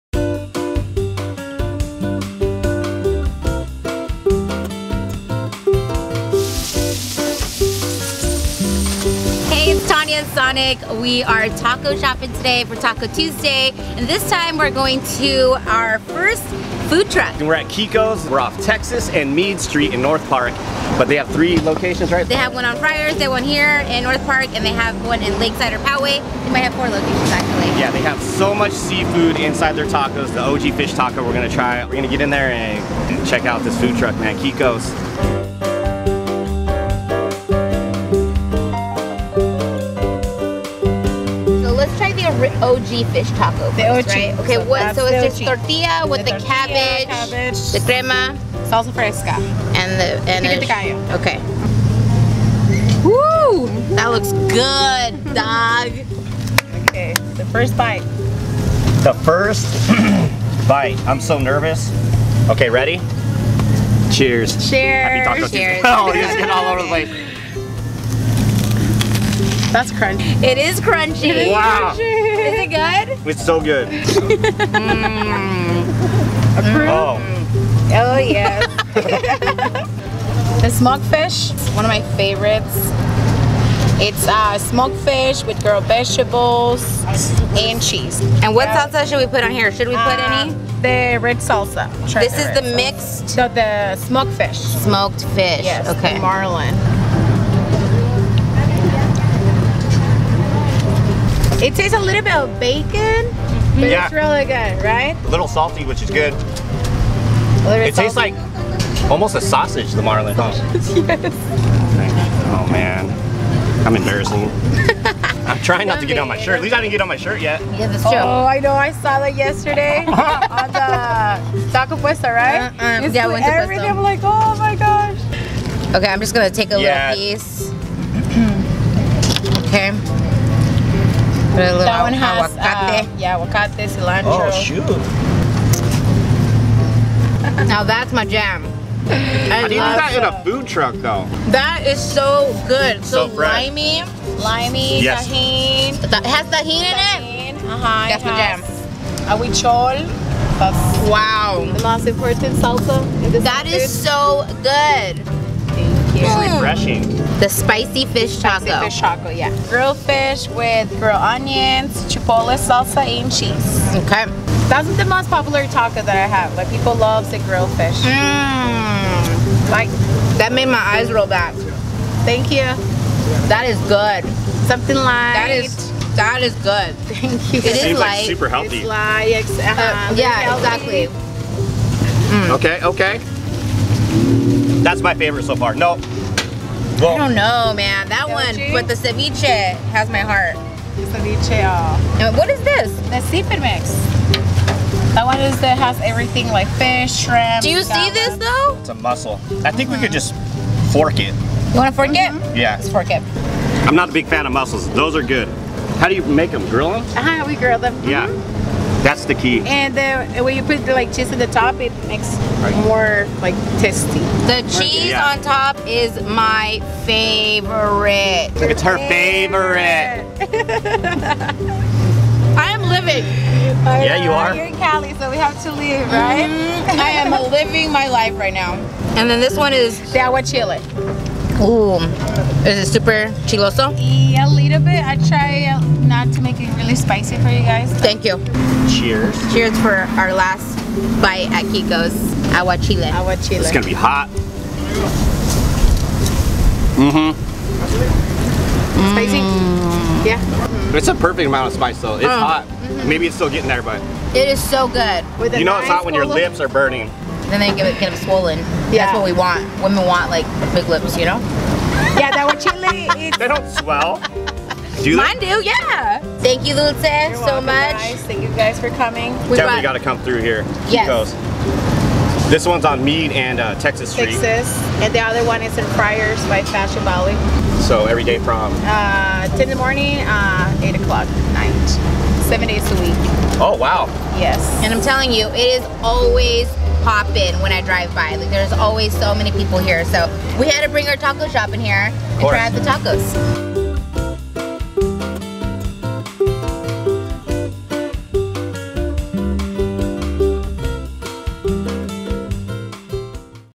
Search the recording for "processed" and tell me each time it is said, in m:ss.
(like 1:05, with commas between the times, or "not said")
not said.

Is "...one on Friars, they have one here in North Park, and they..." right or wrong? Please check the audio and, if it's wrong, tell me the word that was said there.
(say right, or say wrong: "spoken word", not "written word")
right.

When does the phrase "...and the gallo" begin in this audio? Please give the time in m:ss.
0:50.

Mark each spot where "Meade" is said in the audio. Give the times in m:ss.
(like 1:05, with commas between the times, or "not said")
0:19, 4:33.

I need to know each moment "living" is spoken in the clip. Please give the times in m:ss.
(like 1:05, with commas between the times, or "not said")
3:42, 3:47.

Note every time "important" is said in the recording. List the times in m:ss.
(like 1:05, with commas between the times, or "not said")
2:32.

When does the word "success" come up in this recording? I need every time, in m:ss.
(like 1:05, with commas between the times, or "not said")
not said.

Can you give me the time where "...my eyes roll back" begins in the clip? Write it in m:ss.
2:50.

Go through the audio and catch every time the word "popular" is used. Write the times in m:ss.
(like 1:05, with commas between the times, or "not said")
2:45.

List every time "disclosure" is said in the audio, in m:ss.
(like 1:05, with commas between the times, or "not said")
not said.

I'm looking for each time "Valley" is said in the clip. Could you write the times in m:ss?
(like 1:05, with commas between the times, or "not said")
4:37.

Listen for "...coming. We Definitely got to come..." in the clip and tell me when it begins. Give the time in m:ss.
4:28.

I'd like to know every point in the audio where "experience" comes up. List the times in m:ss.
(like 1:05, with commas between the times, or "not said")
not said.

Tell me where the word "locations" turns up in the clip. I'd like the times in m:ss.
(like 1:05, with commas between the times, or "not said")
0:21, 0:26.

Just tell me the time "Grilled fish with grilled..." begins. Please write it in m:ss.
2:39.